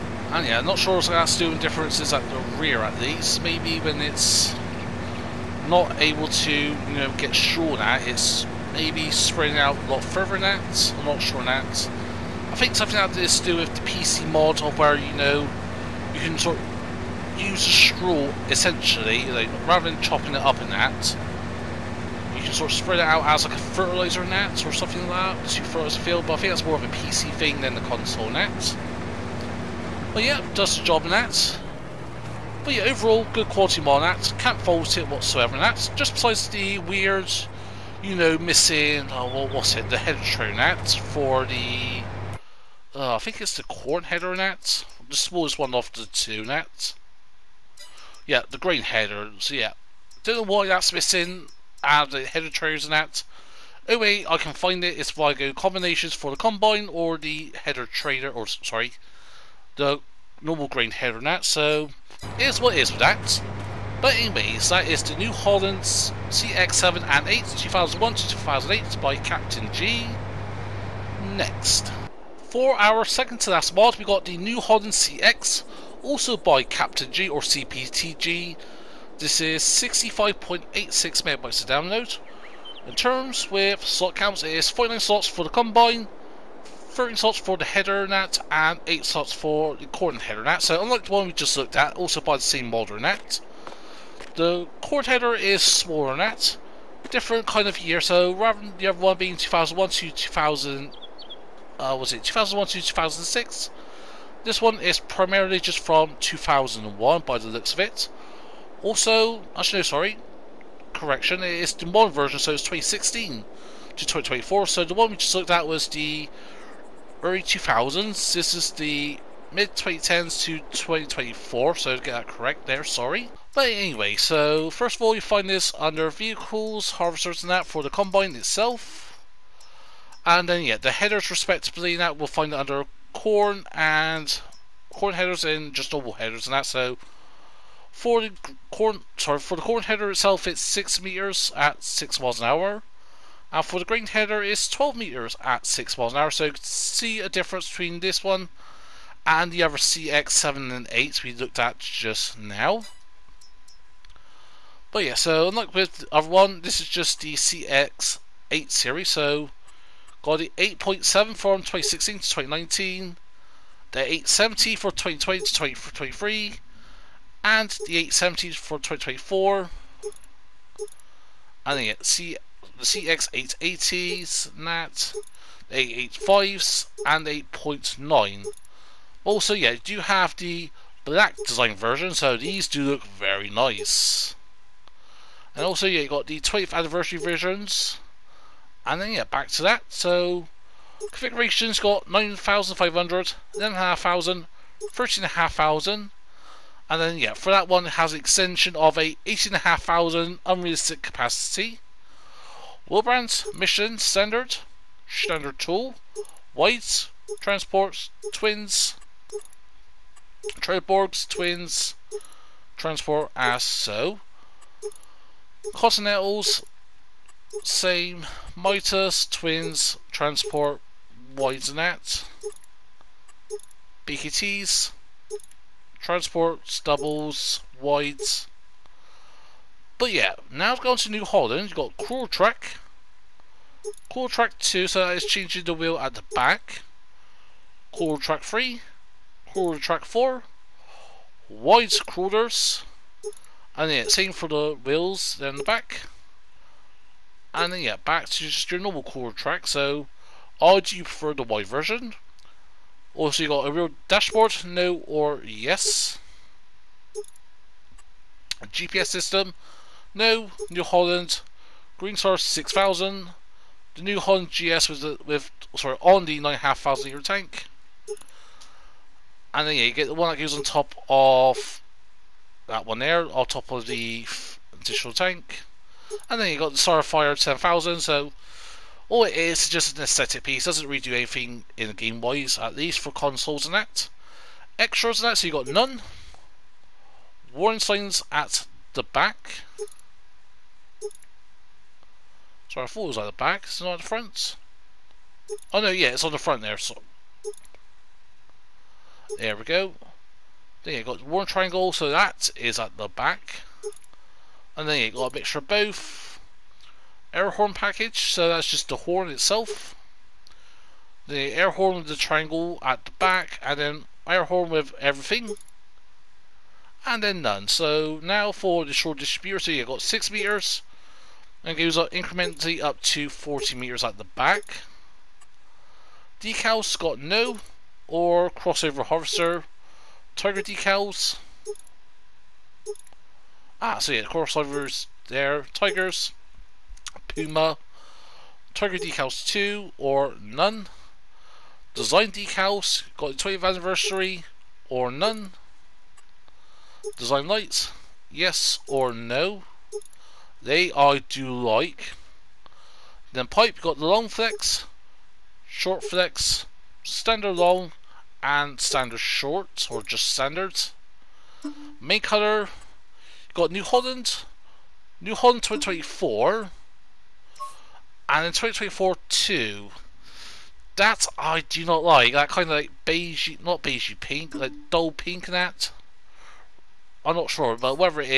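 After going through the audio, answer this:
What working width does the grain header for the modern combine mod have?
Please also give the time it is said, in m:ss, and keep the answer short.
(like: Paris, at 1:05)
12 meters, at 2:24.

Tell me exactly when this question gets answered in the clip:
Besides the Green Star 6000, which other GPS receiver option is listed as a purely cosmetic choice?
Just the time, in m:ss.
4:36.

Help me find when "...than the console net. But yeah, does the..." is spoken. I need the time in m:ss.
0:27.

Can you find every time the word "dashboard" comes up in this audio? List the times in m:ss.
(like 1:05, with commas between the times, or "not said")
4:14.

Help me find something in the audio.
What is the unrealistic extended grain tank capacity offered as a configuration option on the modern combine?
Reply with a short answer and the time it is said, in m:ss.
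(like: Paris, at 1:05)
18,500, at 3:19.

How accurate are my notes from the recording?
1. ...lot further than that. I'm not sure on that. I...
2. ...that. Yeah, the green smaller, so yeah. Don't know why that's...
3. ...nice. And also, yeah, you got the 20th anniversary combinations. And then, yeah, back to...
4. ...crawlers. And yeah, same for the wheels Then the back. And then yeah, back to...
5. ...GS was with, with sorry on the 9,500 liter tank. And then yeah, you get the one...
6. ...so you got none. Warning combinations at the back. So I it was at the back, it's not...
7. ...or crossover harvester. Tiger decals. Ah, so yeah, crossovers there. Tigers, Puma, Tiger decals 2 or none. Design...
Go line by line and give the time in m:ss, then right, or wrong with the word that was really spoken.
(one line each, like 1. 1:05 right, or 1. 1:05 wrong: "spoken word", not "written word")
1. 0:09 right
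2. 0:46 wrong: "header", not "smaller"
3. 3:03 wrong: "versions", not "combinations"
4. 4:02 right
5. 4:24 right
6. 4:45 wrong: "signs", not "combinations"
7. 5:28 right.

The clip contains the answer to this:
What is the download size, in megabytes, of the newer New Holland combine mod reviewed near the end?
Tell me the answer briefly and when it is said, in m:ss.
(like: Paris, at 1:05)
65.86 megabytes, at 1:19.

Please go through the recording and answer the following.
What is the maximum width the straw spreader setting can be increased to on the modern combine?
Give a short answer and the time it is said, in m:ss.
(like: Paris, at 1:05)
40 meters, at 5:23.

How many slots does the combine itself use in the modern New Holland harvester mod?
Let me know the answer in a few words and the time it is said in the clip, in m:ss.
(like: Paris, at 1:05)
49, at 1:24.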